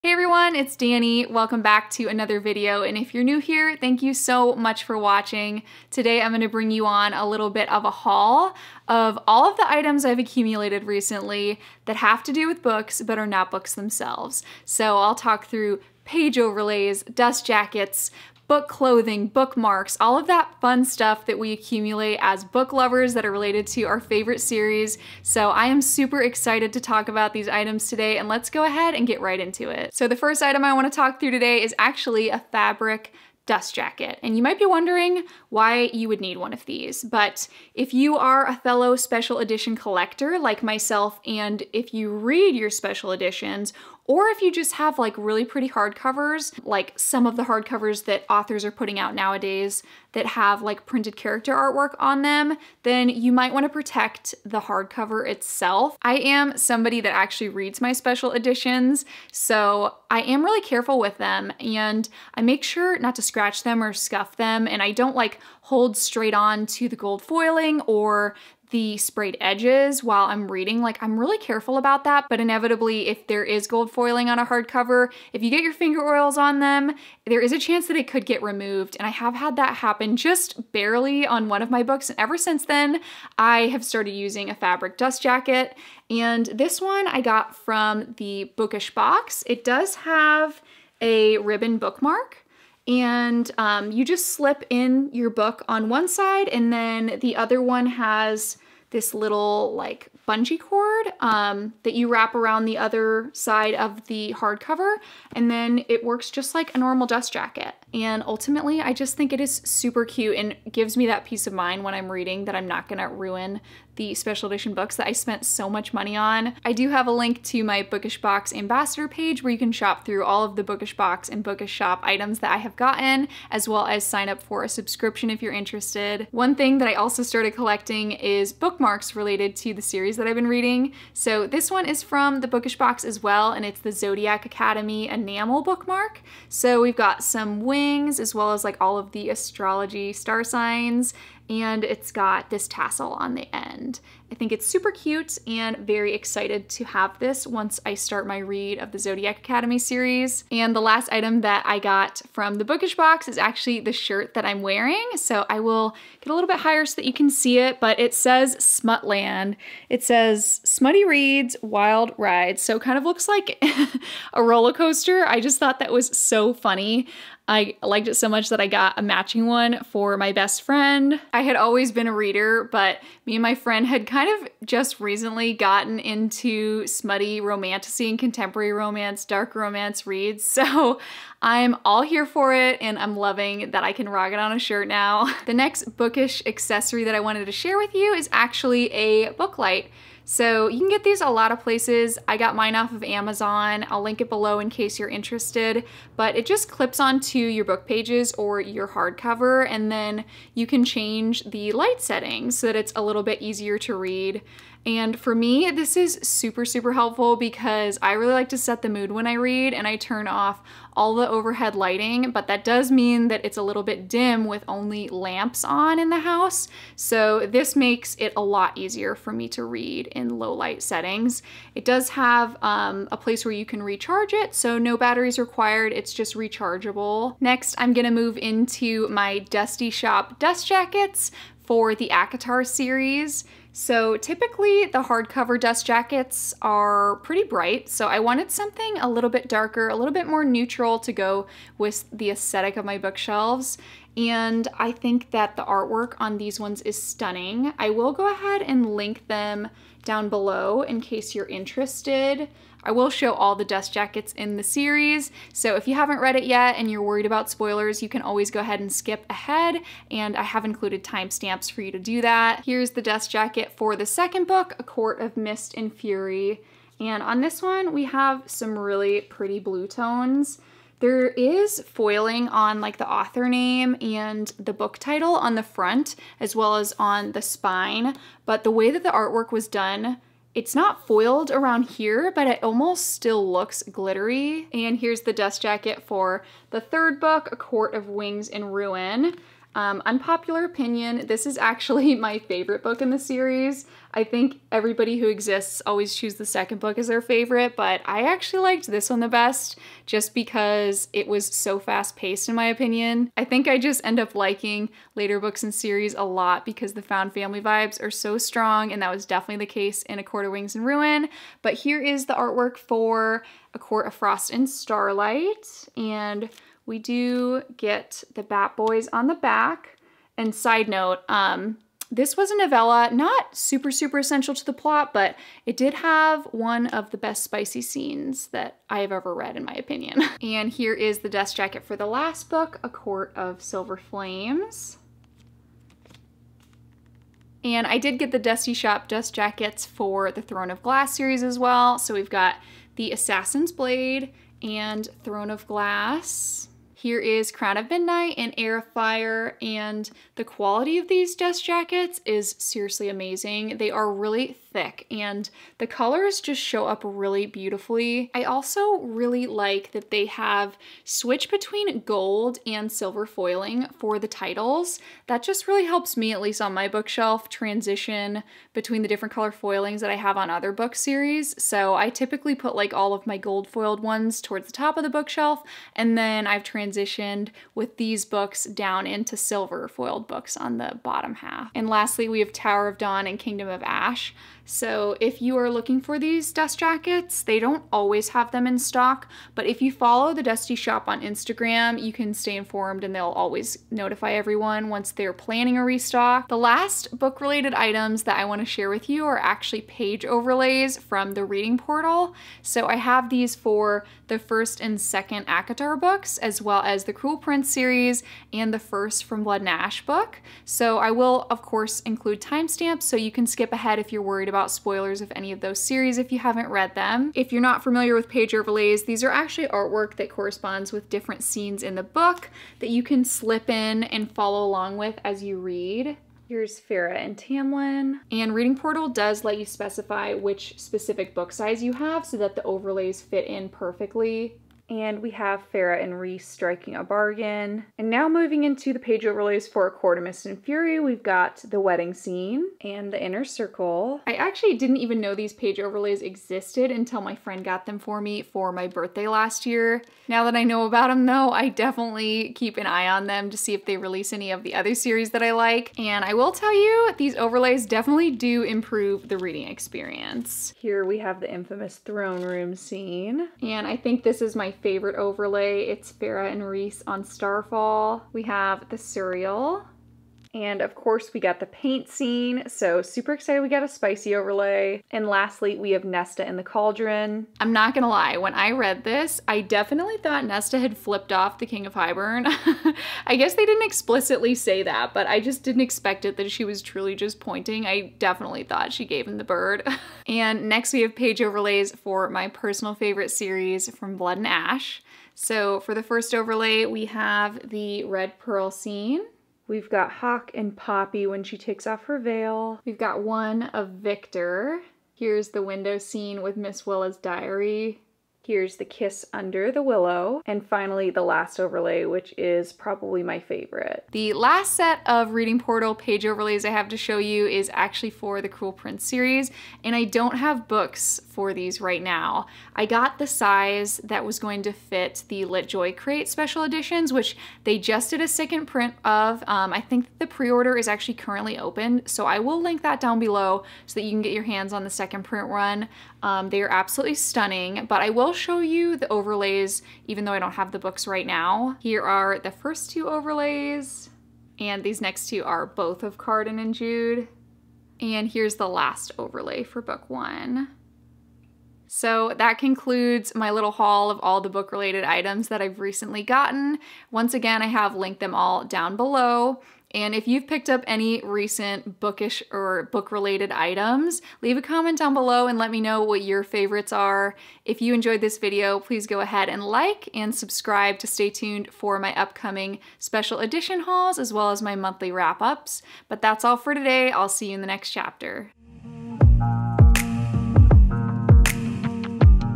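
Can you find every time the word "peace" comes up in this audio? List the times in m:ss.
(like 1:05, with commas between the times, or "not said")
1:51.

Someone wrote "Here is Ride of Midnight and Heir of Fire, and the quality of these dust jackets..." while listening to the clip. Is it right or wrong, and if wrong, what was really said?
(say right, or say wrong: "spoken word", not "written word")
wrong: "Crown", not "Ride".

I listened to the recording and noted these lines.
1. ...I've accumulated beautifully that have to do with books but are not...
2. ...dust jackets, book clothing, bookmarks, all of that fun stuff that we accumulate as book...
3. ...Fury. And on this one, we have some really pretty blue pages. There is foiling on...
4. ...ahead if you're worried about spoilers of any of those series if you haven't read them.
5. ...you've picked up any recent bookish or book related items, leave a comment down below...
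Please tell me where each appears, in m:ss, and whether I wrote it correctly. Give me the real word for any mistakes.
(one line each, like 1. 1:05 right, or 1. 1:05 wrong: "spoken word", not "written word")
1. 0:10 wrong: "recently", not "beautifully"
2. 0:17 right
3. 4:25 wrong: "tones", not "pages"
4. 6:53 right
5. 9:20 right.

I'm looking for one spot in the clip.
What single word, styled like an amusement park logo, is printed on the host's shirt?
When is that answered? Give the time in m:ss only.
2:38.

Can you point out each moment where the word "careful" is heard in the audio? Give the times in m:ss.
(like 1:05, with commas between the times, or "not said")
1:00, 1:11.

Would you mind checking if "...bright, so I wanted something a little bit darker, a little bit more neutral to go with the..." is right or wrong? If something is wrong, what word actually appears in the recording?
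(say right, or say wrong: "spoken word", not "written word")
right.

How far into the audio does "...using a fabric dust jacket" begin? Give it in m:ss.
1:24.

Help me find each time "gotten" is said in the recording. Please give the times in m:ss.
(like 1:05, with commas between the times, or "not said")
2:02, 2:55, 9:16.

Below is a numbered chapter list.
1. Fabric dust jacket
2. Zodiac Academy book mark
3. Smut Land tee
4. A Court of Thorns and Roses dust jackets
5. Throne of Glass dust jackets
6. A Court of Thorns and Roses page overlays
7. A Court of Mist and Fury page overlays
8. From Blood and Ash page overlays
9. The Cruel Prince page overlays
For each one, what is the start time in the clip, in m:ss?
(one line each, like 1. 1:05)
1. 0:35
2. 2:12
3. 2:39
4. 3:52
5. 5:43
6. 6:42
7. 7:17
8. 8:12
9. 8:34.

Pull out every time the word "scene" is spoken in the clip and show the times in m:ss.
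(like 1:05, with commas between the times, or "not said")
5:27, 7:01, 7:22, 7:42, 7:52, 8:18, 8:25.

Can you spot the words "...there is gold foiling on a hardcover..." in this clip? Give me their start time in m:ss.
1:13.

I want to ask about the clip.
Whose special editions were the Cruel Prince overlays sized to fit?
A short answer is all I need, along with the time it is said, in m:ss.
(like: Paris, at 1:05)
Lit Joy Crate, at 8:45.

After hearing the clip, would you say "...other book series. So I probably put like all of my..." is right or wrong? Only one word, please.
wrong.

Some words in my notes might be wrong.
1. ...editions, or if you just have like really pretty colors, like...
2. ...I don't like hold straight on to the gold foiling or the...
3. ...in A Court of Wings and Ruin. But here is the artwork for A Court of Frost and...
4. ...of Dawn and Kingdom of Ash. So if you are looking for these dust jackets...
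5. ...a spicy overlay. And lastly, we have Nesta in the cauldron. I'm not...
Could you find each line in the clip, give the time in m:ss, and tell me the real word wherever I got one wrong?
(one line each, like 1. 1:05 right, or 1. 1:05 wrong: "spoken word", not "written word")
1. 0:43 wrong: "hardcovers", not "colors"
2. 1:04 right
3. 5:10 right
4. 6:22 right
5. 7:53 right.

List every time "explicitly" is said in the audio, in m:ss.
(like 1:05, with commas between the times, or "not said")
8:03.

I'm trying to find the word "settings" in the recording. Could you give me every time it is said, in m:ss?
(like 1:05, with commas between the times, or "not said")
3:22, 3:40.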